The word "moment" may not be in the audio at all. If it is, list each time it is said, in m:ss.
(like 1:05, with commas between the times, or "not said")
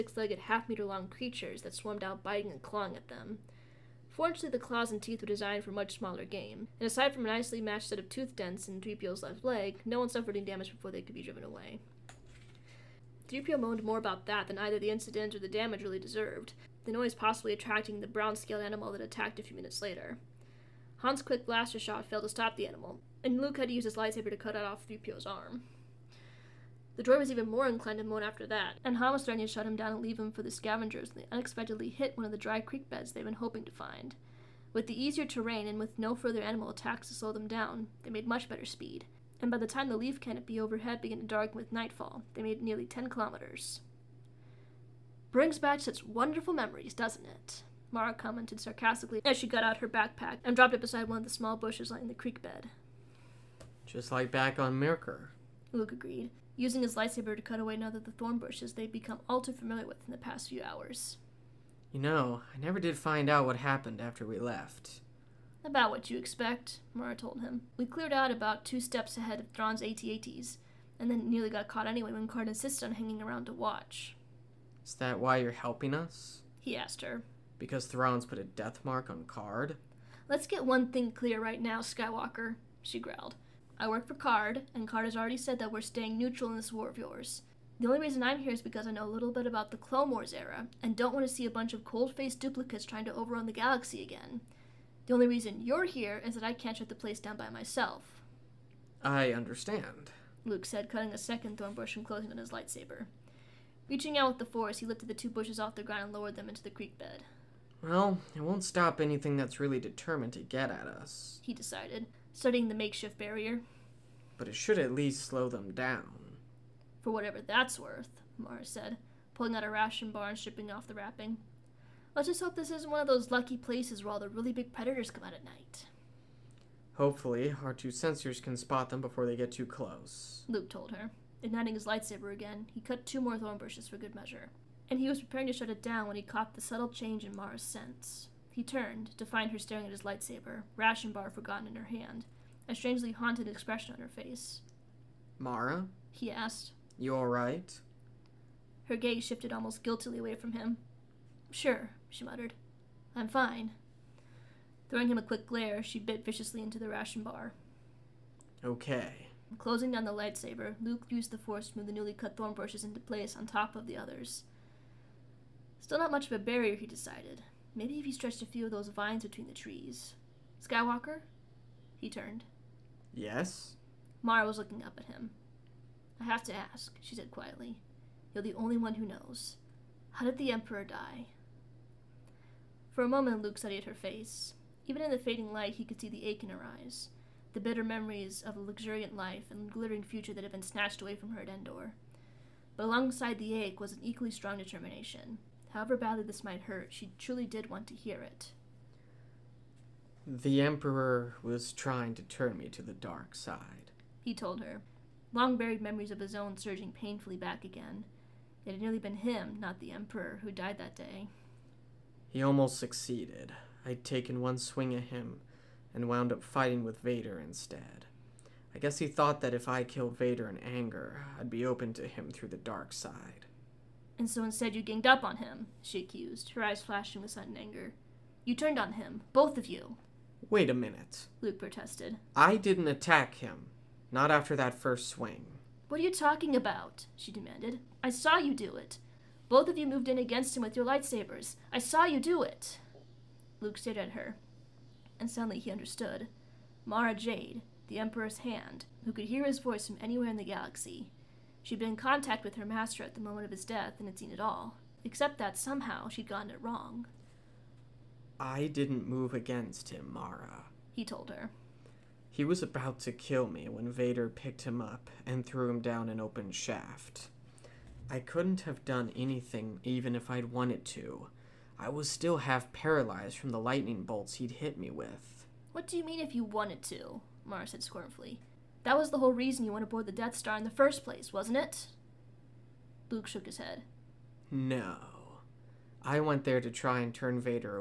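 3:03, 4:13.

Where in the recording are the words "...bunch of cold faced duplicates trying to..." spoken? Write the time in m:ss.
1:31.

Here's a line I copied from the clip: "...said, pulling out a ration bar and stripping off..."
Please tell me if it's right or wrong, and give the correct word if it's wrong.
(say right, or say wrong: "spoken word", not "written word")
right.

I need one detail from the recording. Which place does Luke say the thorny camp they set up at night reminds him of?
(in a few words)
Myrkr.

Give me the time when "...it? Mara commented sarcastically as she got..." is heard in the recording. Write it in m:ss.
0:47.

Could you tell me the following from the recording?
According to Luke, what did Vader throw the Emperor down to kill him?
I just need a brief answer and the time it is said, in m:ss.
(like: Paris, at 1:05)
An open shaft, at 4:26.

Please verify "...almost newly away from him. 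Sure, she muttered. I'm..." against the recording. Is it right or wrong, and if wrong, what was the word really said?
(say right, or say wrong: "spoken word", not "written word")
wrong: "guiltily", not "newly".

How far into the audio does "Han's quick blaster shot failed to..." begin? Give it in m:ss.
0:21.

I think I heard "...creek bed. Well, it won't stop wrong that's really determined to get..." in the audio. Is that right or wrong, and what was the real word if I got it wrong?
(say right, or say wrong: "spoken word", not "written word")
wrong: "anything", not "wrong".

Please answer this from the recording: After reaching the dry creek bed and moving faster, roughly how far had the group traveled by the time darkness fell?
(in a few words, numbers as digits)
10 kilometers.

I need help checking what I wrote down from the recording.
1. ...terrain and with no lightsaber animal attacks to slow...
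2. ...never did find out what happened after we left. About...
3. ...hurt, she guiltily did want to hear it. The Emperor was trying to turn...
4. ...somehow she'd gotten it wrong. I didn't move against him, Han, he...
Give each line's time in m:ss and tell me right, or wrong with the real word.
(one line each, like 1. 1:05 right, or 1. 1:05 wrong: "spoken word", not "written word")
1. 0:35 wrong: "further", not "lightsaber"
2. 1:02 right
3. 3:16 wrong: "truly", not "guiltily"
4. 4:15 wrong: "Mara", not "Han".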